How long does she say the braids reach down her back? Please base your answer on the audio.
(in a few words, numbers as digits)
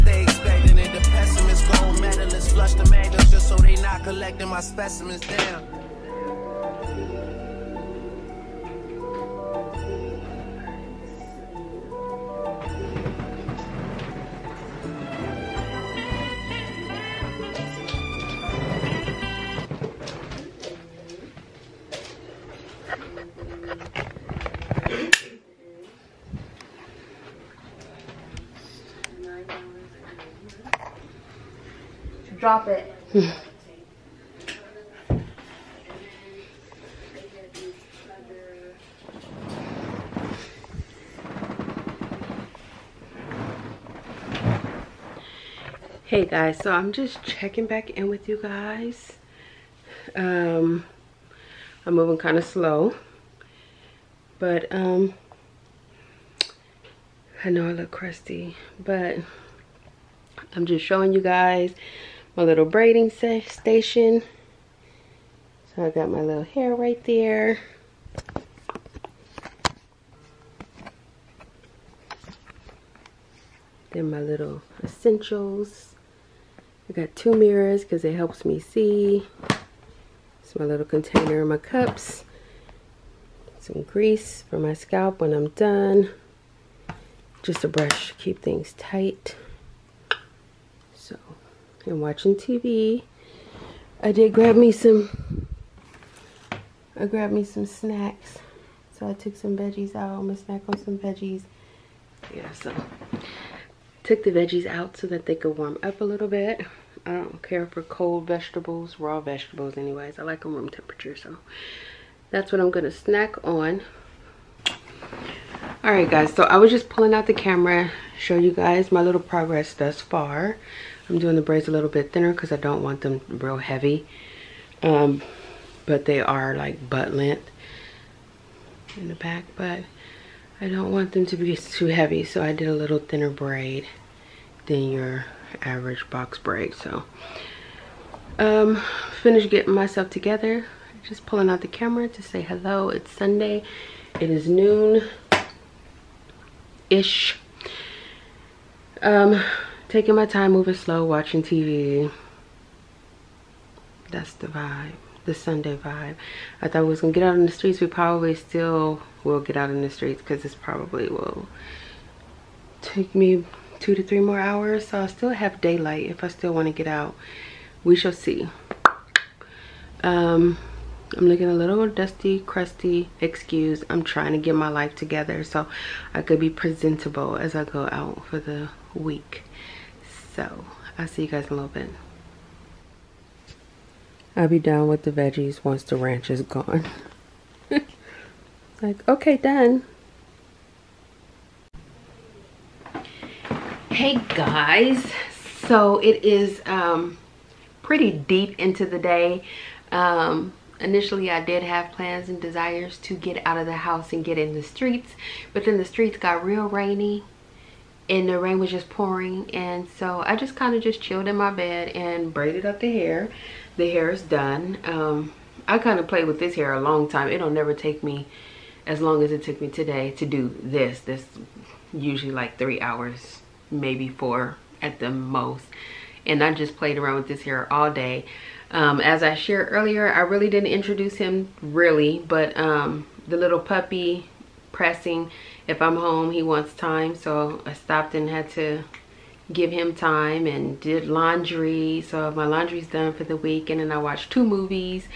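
butt length.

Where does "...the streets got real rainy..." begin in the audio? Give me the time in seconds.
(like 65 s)
205 s.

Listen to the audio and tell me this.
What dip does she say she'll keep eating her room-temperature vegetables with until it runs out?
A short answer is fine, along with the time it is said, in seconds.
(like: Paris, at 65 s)
ranch, at 185 s.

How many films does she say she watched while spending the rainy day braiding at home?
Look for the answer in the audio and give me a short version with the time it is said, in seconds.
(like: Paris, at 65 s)
2, at 244 s.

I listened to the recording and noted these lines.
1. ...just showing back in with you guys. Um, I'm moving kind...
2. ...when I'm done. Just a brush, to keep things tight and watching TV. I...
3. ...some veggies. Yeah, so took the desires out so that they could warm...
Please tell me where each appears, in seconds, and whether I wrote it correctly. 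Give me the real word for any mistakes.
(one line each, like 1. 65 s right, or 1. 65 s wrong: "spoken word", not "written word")
1. 46 s wrong: "checking", not "showing"
2. 85 s right
3. 100 s wrong: "veggies", not "desires".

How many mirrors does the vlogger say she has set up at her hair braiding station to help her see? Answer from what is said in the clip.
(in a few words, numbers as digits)
2.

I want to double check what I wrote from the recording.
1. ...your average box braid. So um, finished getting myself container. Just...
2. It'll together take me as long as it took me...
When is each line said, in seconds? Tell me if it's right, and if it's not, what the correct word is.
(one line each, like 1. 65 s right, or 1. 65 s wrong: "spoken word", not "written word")
1. 134 s wrong: "together", not "container"
2. 217 s wrong: "never", not "together".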